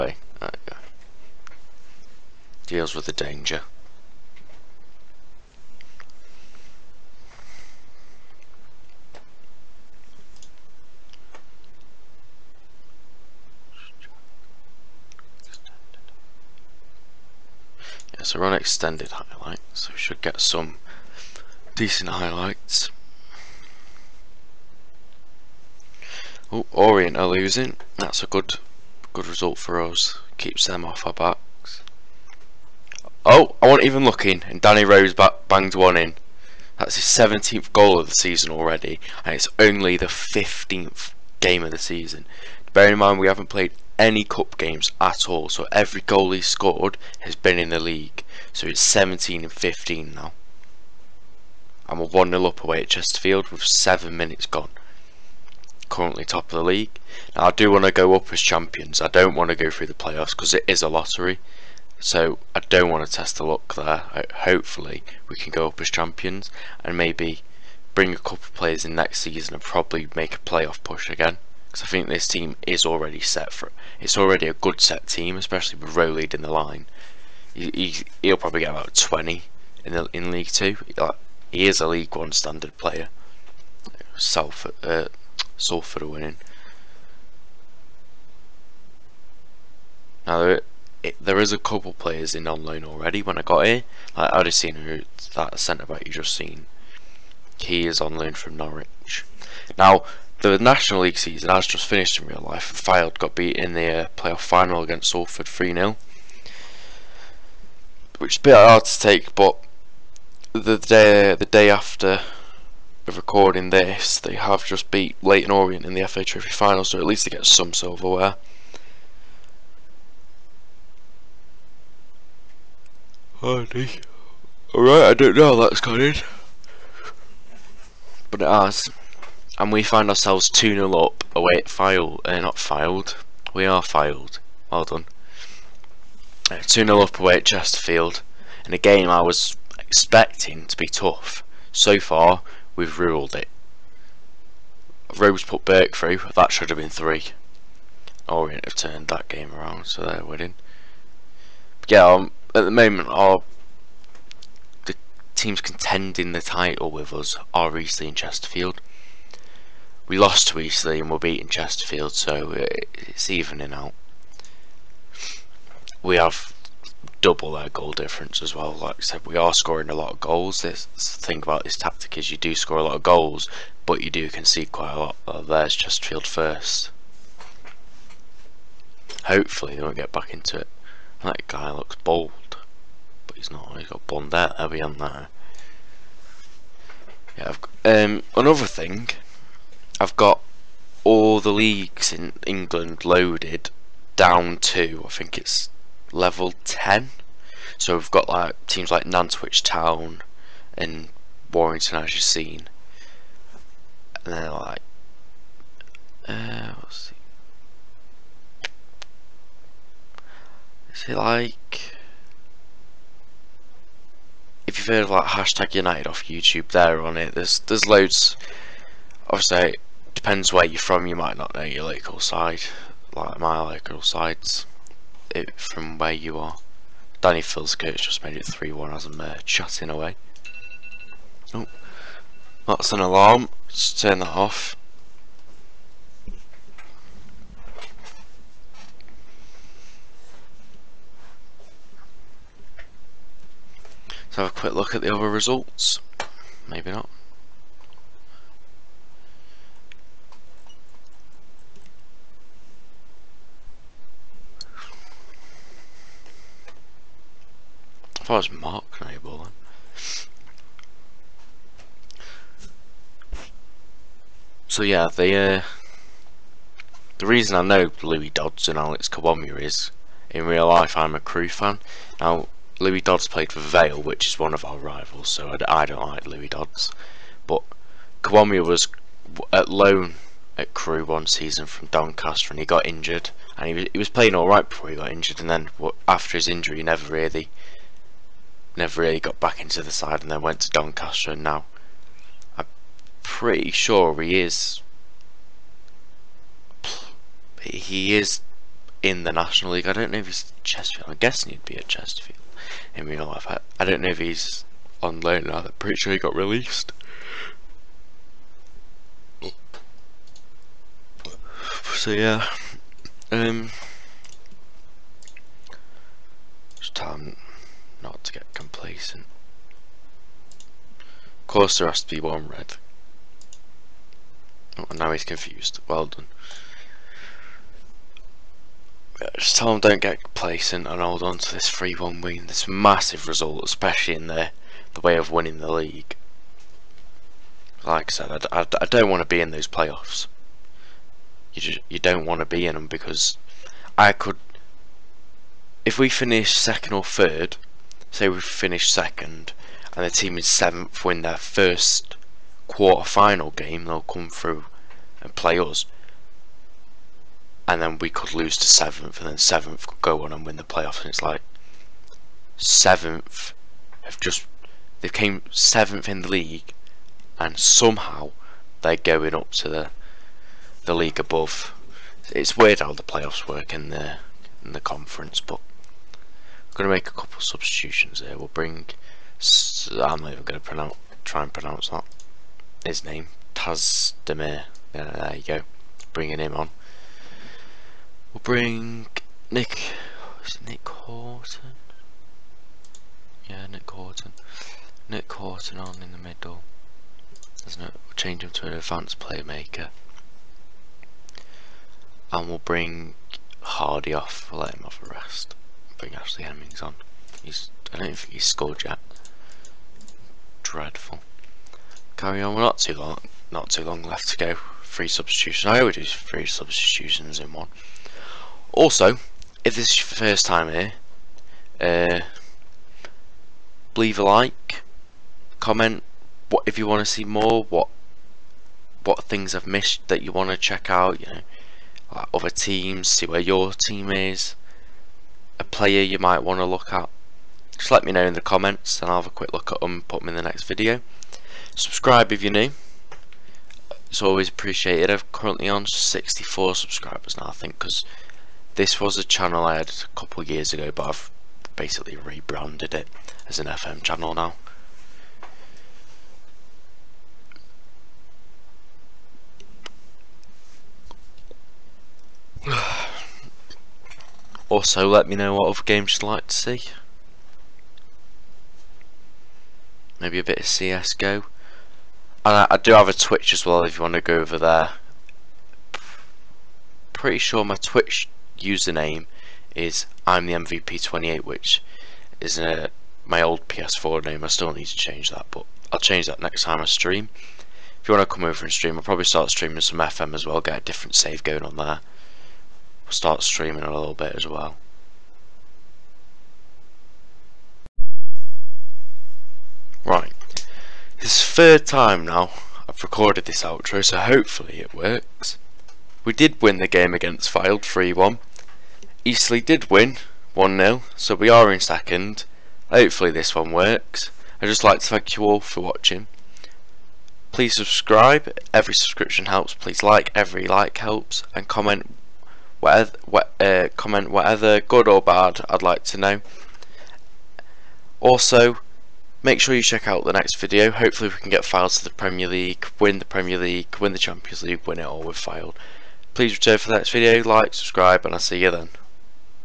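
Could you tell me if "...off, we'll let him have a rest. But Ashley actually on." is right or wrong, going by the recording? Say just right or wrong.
right.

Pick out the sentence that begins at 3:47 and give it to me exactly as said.
Danny coach just made it 3-1 as I'm uh, chatting away.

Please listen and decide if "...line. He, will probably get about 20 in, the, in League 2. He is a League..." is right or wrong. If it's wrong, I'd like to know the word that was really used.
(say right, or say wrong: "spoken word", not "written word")
right.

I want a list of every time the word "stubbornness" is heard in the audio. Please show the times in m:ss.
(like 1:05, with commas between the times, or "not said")
not said.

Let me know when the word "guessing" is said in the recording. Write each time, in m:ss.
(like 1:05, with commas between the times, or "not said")
5:01.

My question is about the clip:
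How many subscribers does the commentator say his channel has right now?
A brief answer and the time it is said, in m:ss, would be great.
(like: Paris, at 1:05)
64, at 7:25.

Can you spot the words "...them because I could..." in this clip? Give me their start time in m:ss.
5:42.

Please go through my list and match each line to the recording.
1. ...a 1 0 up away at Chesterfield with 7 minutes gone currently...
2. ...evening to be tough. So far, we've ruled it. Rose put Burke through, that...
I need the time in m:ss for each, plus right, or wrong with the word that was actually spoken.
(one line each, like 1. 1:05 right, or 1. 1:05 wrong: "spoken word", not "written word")
1. 0:52 right
2. 2:19 wrong: "expecting", not "evening".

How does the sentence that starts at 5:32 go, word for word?
This massive result, especially in the, the way of winning the league.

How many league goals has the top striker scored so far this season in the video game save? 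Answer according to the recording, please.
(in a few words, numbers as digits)
17.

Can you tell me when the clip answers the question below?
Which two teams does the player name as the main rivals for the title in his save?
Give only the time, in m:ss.
2:37.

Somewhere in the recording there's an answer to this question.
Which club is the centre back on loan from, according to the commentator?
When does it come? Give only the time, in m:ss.
1:38.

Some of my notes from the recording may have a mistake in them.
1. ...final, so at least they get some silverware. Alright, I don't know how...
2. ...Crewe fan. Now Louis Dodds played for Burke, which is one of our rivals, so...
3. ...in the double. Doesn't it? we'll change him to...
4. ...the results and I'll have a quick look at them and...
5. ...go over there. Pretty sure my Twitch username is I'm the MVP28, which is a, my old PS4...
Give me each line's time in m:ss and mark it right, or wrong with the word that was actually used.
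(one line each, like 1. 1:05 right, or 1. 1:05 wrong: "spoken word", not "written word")
1. 1:56 right
2. 4:31 wrong: "Vale", not "Burke"
3. 6:36 wrong: "middle", not "double"
4. 7:18 wrong: "comments", not "results"
5. 7:54 right.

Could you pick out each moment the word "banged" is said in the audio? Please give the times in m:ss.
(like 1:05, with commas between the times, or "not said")
0:35.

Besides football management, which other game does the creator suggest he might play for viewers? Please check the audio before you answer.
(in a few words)
CSGO.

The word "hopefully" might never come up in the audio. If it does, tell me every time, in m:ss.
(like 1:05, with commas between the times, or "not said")
1:04, 2:59, 8:24, 8:32, 8:50.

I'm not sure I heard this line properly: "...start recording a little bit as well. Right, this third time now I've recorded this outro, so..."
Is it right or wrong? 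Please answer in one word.
wrong.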